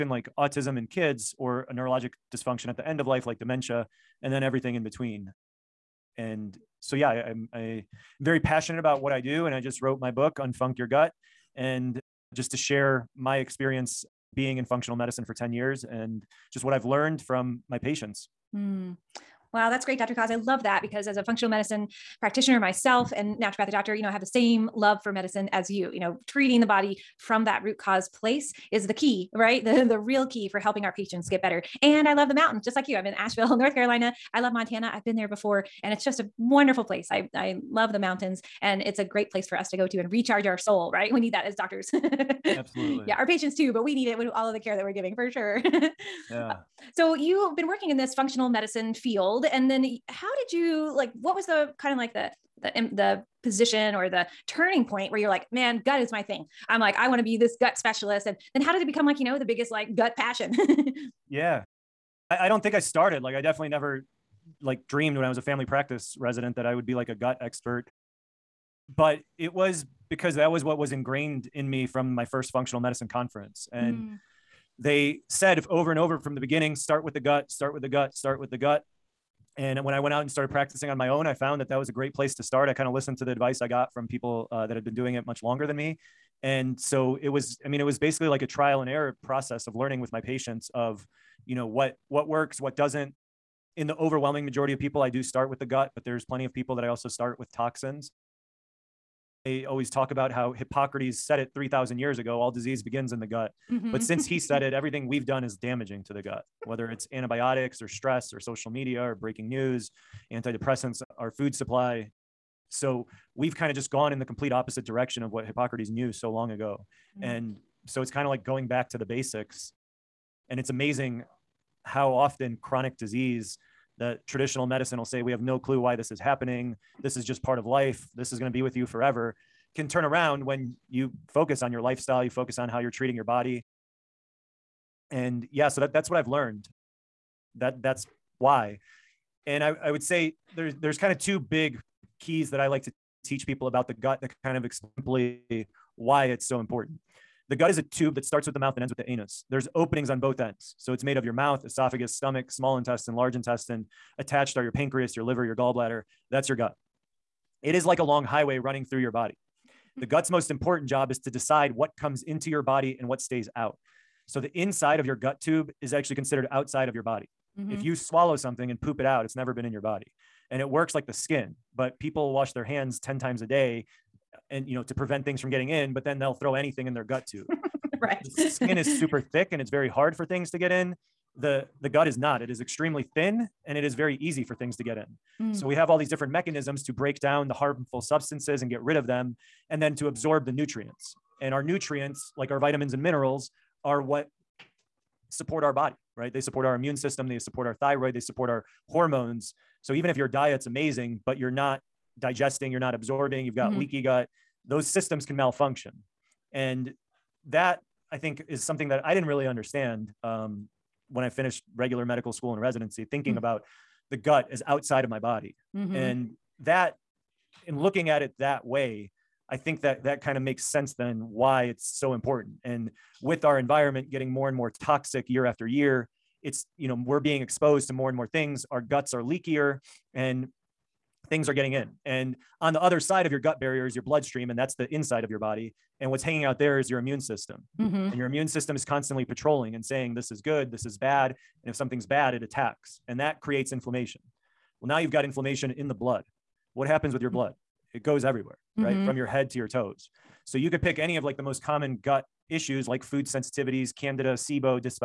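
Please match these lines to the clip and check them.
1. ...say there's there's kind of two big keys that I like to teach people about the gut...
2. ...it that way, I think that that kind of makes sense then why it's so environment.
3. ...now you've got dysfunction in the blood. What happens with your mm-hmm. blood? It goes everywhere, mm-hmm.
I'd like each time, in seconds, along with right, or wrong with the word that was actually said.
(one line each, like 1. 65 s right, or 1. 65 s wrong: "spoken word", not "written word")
1. 140 s right
2. 218 s wrong: "important", not "environment"
3. 244 s wrong: "inflammation", not "dysfunction".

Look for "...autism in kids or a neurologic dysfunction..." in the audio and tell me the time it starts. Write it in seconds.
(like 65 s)
0 s.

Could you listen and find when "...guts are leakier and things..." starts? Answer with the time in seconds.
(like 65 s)
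228 s.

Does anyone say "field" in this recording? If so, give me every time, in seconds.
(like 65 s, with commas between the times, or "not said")
48 s.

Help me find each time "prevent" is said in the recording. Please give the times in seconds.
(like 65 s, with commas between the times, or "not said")
174 s.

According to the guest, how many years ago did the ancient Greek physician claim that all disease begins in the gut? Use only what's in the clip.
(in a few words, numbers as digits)
3,000.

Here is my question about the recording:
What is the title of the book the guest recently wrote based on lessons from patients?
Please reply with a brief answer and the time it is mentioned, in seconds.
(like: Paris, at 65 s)
Unfunc Your Gut, at 10 s.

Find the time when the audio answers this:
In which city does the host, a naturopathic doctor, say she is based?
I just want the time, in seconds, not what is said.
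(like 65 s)
33 s.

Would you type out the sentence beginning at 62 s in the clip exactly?
I, I don't think I started.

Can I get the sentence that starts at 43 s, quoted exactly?
Yeah, our patients too, but we need it with all of the care that we're giving for sure.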